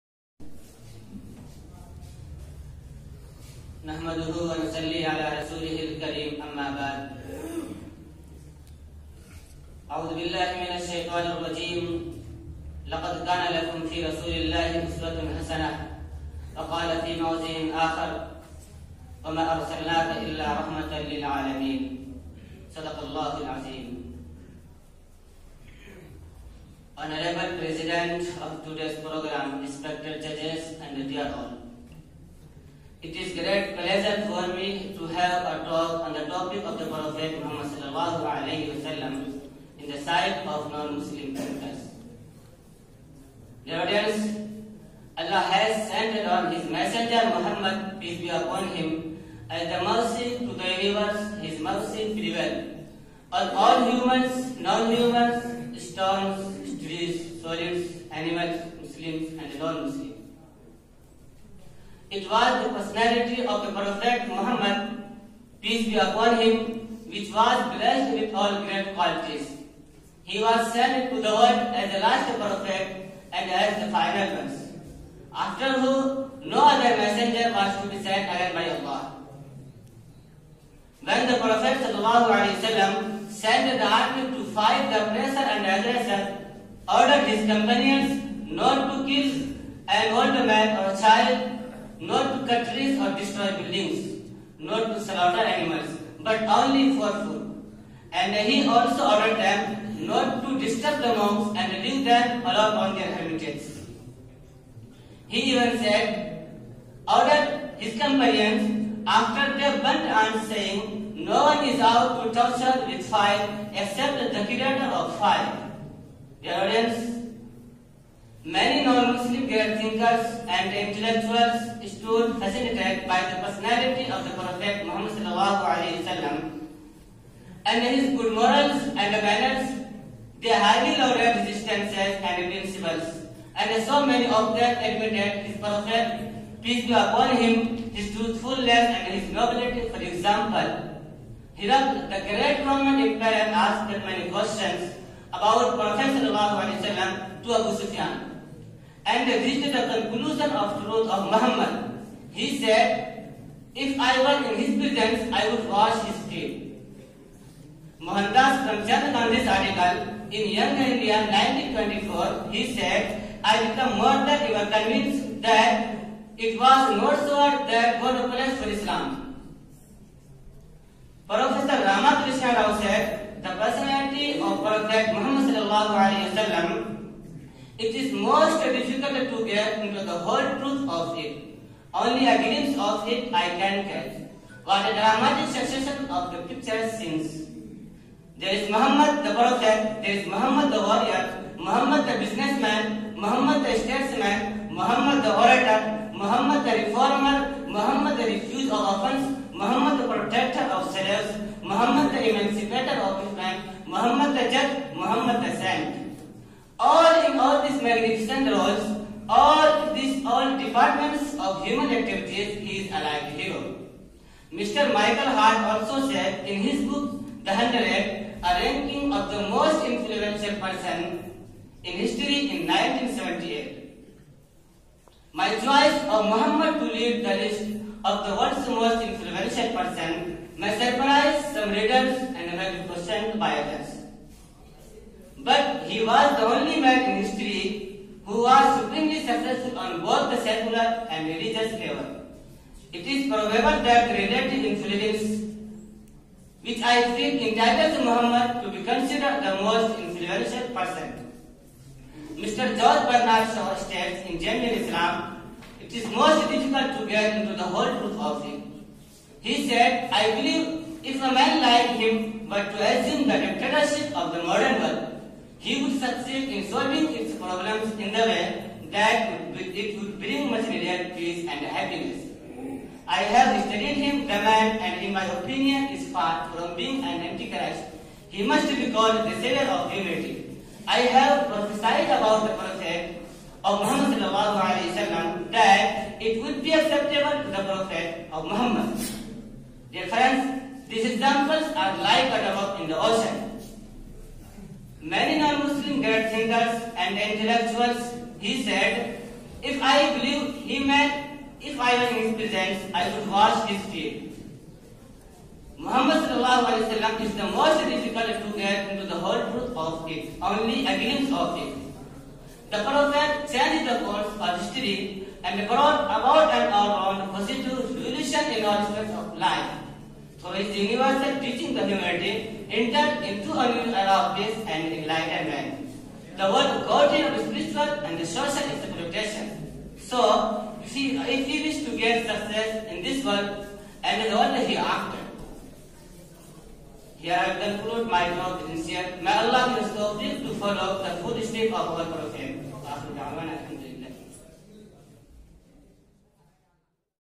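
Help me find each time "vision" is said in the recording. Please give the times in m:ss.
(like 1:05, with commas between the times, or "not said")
not said.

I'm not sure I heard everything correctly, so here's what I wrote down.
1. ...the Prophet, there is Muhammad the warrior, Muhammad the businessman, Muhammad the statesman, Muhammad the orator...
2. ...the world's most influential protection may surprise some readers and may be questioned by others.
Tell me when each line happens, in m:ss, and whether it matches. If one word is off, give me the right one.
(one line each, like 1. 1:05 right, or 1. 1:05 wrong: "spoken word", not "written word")
1. 3:09 right
2. 3:48 wrong: "person", not "protection".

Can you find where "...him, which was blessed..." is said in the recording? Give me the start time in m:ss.
1:06.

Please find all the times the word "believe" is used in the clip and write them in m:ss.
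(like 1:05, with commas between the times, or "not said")
4:20, 5:00.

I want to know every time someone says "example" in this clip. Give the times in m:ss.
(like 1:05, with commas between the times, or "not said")
2:20, 4:51.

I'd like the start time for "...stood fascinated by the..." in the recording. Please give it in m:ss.
2:01.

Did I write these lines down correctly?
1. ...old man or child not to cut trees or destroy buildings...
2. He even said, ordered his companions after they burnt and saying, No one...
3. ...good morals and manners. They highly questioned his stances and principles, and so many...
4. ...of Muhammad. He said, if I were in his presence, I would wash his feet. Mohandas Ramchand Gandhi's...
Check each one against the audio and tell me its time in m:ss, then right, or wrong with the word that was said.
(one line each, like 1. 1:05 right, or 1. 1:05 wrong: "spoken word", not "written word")
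1. 1:30 right
2. 1:45 right
3. 2:08 wrong: "lauded", not "questioned"
4. 2:31 right.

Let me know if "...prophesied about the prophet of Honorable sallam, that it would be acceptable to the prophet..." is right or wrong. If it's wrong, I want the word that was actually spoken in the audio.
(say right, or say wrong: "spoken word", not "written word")
wrong: "Muhammad", not "Honorable".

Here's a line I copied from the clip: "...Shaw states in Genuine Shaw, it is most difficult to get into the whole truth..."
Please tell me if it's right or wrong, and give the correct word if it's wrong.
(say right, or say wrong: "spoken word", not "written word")
wrong: "Islam", not "Shaw".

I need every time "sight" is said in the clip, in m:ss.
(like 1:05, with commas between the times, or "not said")
0:39.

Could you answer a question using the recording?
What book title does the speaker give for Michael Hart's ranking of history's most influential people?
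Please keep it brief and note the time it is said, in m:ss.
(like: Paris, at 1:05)
The Hundred, at 3:37.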